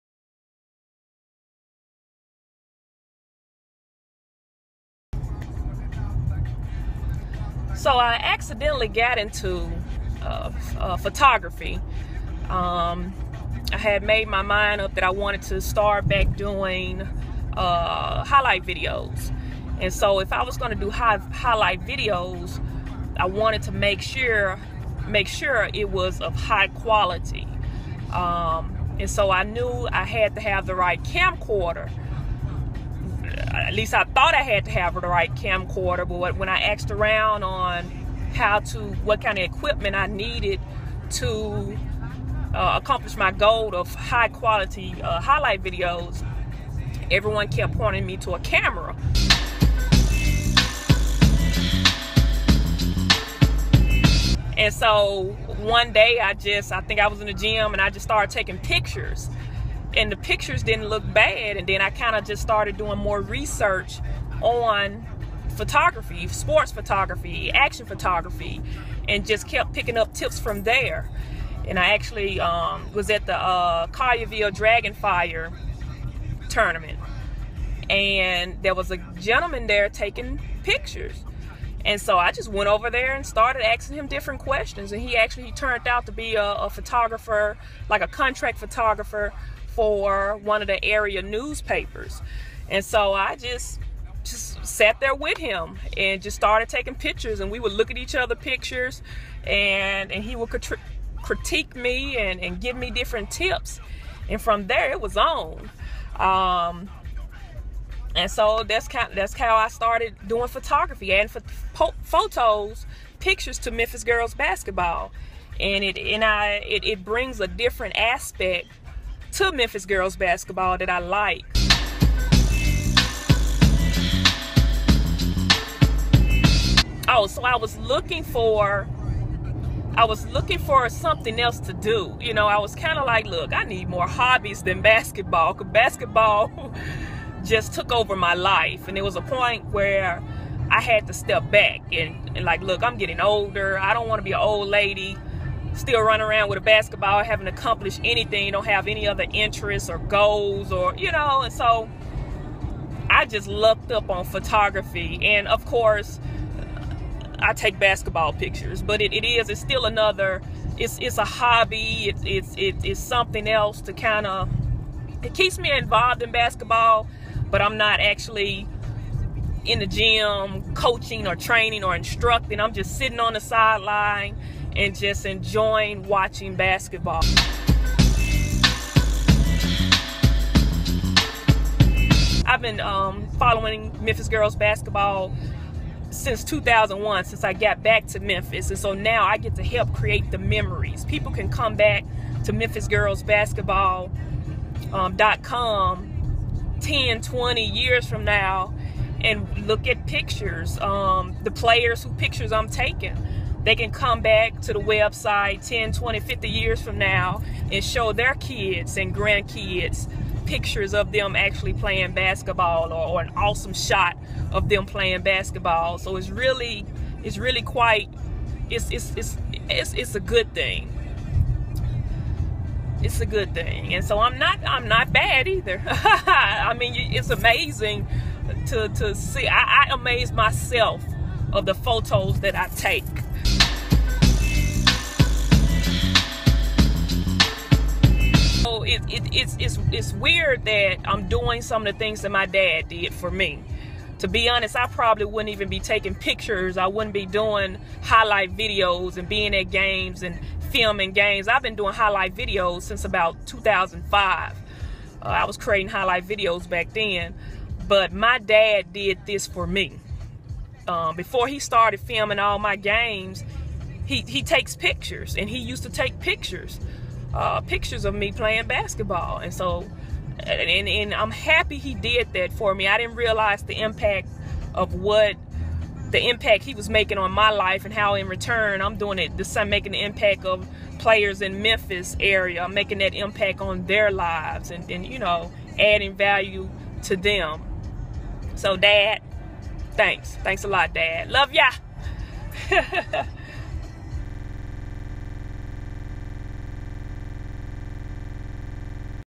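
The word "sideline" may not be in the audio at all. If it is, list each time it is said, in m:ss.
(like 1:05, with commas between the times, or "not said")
2:53.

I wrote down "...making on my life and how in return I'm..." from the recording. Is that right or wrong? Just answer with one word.
right.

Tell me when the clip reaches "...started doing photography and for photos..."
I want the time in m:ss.
1:49.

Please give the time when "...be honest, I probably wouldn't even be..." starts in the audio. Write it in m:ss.
4:04.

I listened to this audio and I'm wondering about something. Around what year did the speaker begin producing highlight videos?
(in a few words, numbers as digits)
2005.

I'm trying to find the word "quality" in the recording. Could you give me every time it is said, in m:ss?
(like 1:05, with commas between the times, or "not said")
0:26, 0:44.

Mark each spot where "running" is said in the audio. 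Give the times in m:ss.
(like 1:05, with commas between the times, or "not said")
2:26.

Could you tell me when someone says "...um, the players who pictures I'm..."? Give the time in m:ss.
3:20.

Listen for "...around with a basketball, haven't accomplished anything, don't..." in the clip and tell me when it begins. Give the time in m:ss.
2:26.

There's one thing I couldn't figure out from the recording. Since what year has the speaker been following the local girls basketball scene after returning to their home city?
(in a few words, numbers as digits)
2001.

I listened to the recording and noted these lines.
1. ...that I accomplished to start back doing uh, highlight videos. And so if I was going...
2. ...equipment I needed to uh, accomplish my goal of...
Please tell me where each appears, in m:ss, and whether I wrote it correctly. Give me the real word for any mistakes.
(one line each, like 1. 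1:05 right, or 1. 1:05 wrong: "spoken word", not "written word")
1. 0:14 wrong: "wanted", not "accomplished"
2. 0:39 right.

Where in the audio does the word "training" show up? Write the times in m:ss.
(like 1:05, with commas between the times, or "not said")
2:51.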